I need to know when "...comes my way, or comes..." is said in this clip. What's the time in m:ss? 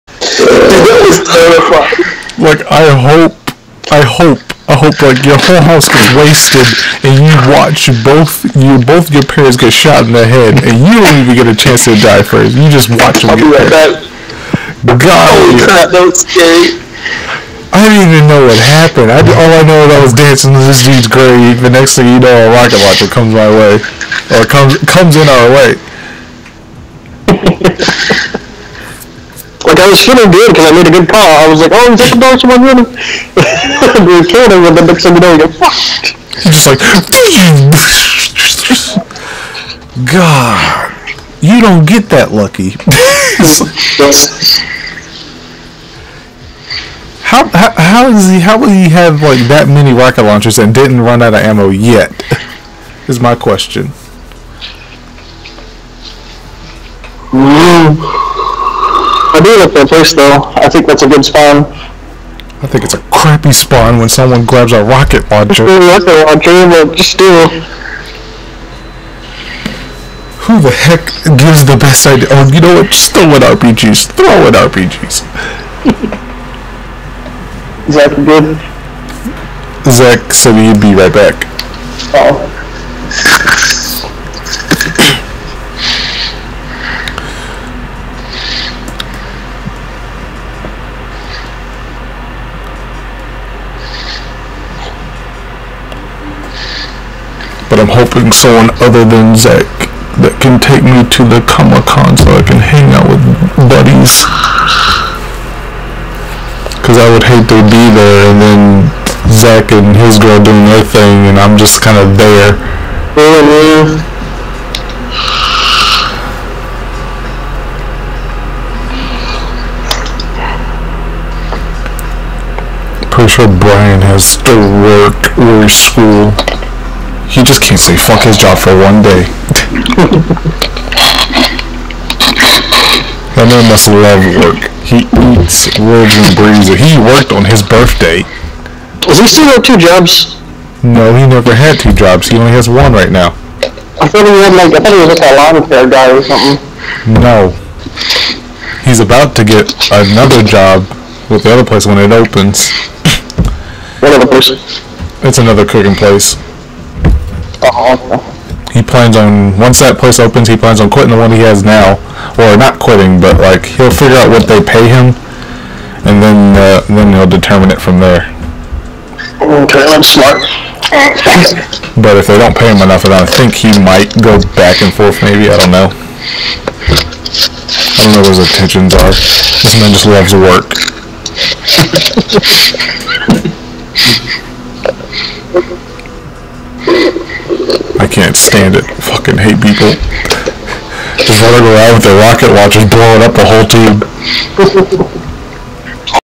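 0:23.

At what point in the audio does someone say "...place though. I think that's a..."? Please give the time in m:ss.
0:59.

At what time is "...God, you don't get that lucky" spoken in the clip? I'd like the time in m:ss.
0:40.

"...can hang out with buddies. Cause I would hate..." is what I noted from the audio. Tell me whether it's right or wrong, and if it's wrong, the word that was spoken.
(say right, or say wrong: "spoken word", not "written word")
right.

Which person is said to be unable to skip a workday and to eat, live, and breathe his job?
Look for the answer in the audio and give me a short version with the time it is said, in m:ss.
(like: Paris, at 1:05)
Brian, at 2:03.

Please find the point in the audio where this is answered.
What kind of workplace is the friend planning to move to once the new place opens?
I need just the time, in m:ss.
2:35.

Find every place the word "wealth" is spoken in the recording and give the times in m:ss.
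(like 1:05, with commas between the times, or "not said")
not said.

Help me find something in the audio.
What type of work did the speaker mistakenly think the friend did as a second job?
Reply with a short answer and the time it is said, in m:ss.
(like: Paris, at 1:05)
lawn care, at 2:25.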